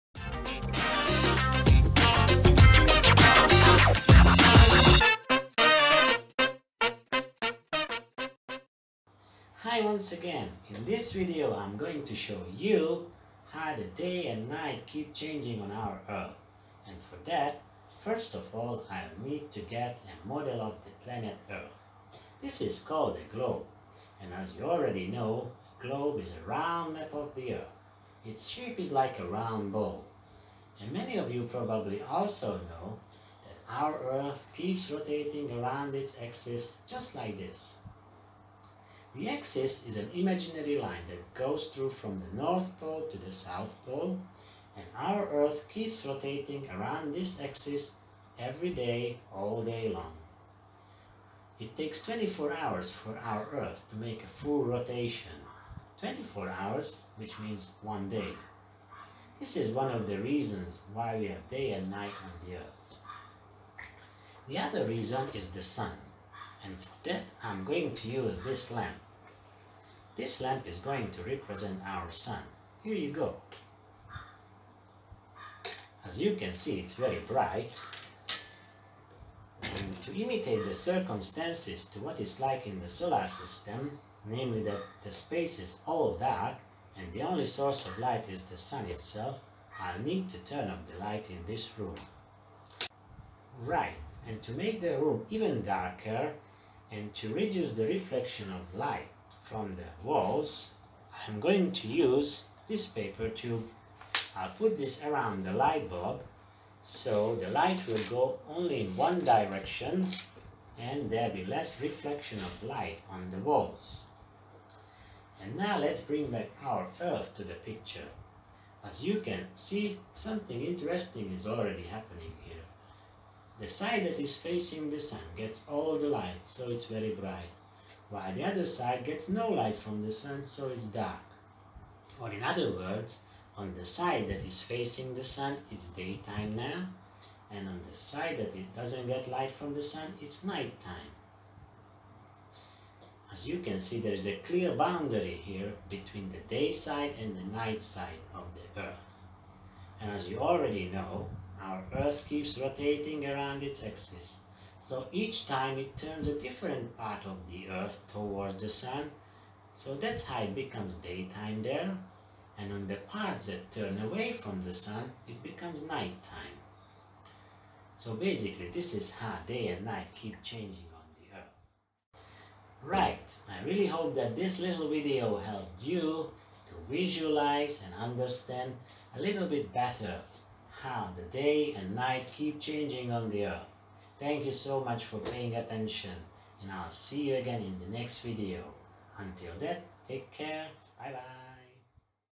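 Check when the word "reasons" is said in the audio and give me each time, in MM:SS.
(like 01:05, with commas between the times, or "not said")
01:00, 01:04.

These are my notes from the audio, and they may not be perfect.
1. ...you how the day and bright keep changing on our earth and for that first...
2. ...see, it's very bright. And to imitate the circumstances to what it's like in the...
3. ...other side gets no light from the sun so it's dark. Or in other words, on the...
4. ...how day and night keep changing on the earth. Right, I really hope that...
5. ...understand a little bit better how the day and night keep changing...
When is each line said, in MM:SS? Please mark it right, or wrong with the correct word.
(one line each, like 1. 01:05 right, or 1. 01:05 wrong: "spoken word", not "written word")
1. 00:12 wrong: "night", not "bright"
2. 01:16 right
3. 02:08 right
4. 02:49 right
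5. 02:57 right.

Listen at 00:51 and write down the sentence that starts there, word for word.
It takes 24 hours for our Earth to make a full rotation.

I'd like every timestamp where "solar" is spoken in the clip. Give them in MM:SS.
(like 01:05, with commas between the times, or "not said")
01:22.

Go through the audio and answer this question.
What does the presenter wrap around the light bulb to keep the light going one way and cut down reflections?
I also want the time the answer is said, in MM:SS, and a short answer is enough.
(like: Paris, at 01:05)
paper tube, at 01:42.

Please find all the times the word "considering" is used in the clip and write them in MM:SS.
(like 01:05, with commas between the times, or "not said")
not said.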